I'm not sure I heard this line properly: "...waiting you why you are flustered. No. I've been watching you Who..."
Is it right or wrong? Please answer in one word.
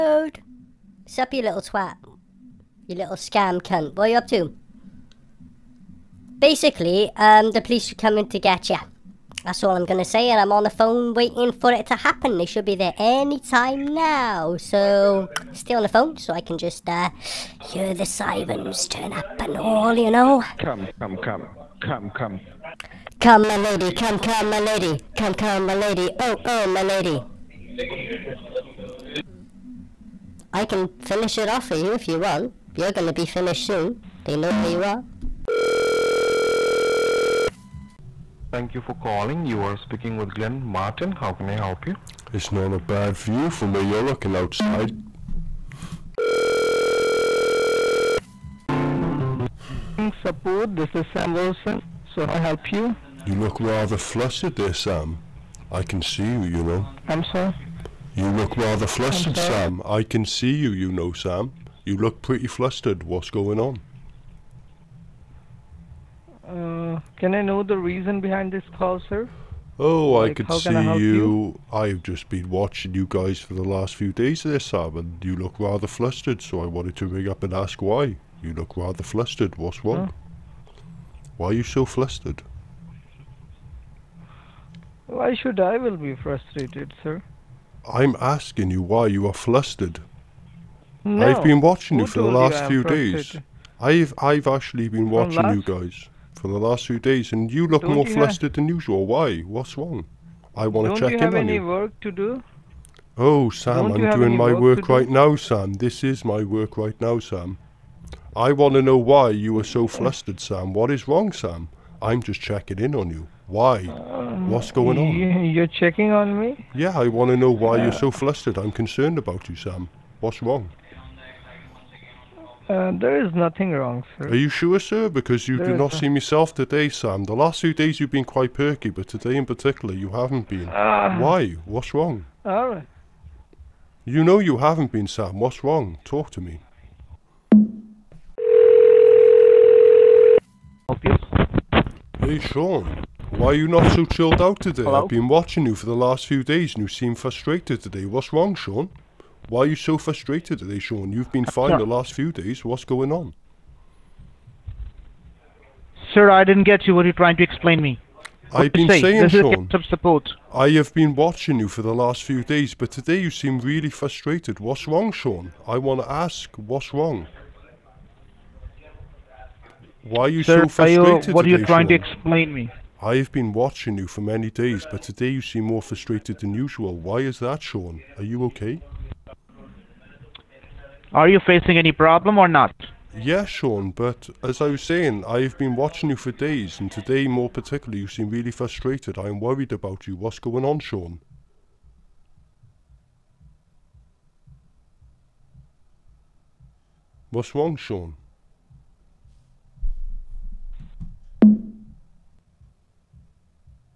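wrong.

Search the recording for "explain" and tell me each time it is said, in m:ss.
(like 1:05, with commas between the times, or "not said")
2:37, 2:52.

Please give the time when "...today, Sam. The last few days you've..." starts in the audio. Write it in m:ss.
2:06.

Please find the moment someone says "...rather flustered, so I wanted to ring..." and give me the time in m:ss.
1:15.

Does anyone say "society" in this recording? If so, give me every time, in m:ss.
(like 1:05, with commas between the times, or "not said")
not said.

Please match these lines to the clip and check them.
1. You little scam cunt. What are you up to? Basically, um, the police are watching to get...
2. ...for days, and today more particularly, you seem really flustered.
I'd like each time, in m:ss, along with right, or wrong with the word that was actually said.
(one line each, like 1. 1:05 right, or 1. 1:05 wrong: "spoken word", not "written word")
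1. 0:02 wrong: "coming", not "watching"
2. 3:06 wrong: "frustrated", not "flustered".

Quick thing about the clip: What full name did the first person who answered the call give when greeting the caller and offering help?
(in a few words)
Glenn Martin.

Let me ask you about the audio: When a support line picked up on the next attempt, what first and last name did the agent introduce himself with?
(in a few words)
Sam Wilson.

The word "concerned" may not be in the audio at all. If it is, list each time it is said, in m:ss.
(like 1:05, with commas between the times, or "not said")
1:58.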